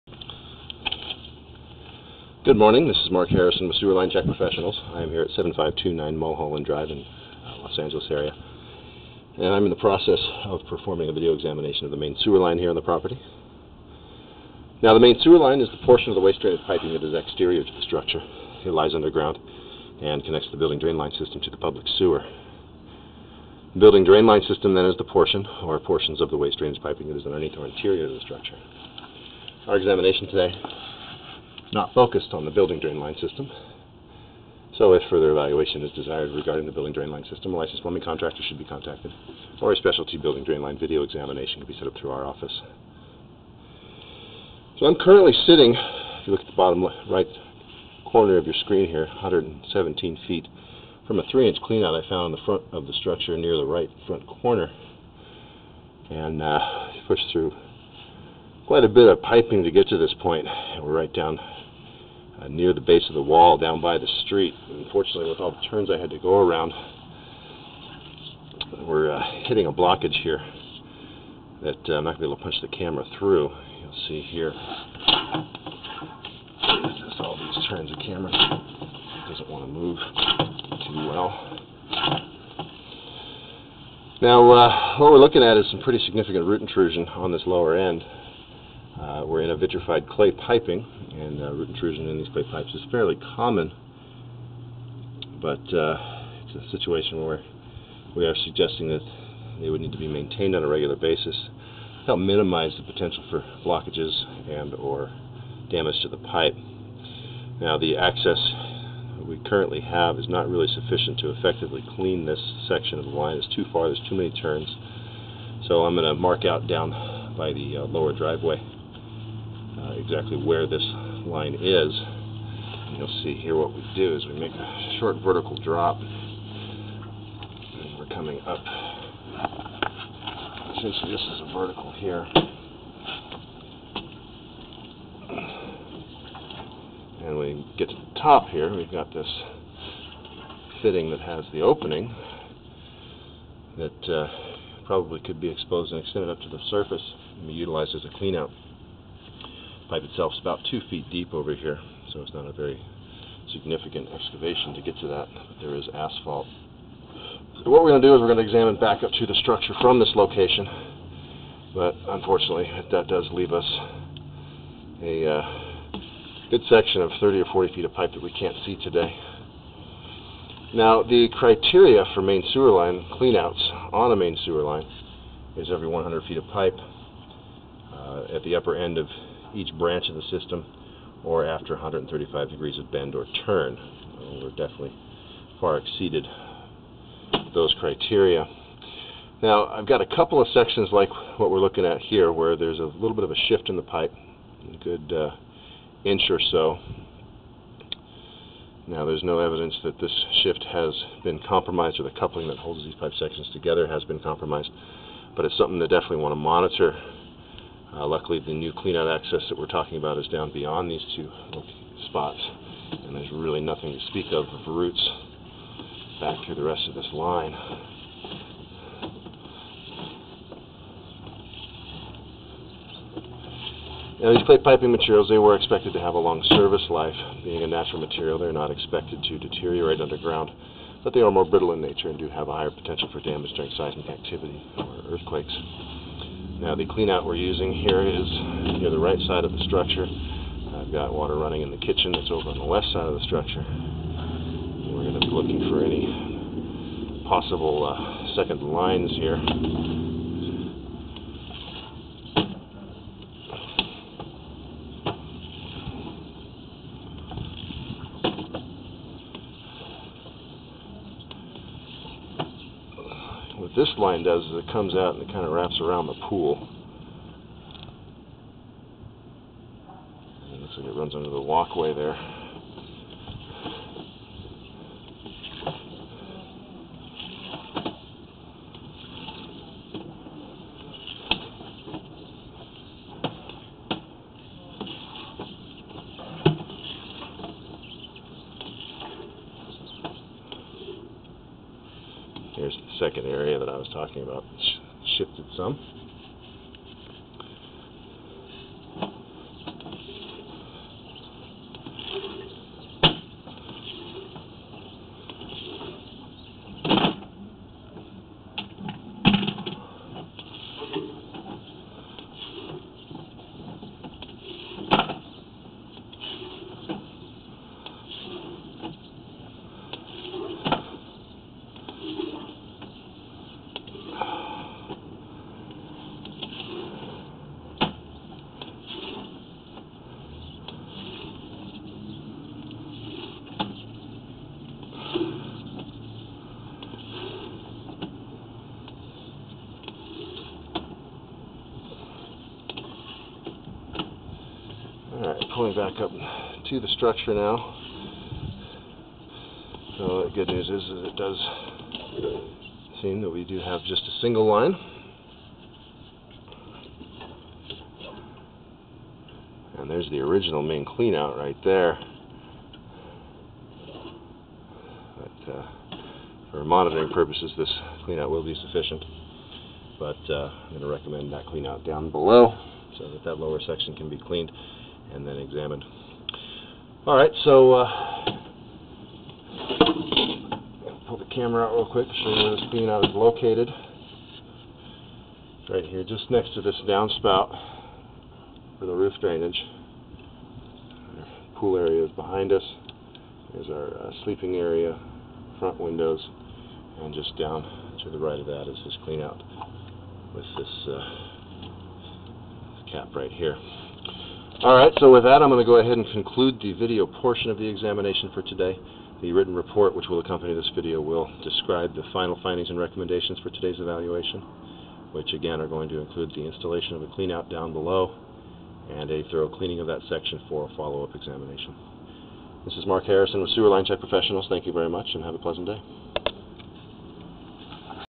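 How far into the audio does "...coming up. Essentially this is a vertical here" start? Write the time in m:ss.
2:08.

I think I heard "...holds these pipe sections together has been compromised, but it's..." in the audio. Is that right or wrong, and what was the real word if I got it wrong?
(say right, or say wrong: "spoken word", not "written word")
right.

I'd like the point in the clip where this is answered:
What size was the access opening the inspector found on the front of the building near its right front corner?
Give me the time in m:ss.
0:51.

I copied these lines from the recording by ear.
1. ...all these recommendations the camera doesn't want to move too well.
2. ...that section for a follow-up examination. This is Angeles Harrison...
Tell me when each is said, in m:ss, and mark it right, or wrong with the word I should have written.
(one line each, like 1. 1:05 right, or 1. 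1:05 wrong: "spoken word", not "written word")
1. 1:17 wrong: "turns", not "recommendations"
2. 6:59 wrong: "Mark", not "Angeles".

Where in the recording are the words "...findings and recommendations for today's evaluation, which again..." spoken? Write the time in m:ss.
6:52.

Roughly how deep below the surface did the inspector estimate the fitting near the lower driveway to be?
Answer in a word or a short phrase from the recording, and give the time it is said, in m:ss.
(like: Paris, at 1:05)
2 feet, at 2:30.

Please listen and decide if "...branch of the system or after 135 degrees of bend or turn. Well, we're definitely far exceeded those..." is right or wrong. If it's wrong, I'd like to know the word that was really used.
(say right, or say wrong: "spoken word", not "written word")
right.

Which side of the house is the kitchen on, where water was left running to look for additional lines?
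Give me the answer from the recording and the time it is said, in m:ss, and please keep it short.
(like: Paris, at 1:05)
west, at 4:02.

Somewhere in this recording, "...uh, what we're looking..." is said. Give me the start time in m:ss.
1:24.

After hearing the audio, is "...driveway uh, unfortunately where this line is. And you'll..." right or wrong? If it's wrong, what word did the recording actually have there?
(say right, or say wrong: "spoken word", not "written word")
wrong: "exactly", not "unfortunately".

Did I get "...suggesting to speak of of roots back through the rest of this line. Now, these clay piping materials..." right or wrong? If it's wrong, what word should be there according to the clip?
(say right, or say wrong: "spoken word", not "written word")
wrong: "nothing", not "suggesting".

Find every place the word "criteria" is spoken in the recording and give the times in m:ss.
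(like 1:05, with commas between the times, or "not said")
2:51, 3:07.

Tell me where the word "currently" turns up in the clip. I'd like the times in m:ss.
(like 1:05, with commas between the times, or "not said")
0:44, 1:49.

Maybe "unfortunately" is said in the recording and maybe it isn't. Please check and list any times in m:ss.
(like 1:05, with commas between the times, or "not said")
1:04, 2:42.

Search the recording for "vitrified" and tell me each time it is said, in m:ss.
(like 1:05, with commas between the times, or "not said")
1:29.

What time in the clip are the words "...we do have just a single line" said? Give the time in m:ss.
5:53.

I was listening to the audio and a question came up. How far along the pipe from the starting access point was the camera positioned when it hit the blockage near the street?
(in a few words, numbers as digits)
117 feet.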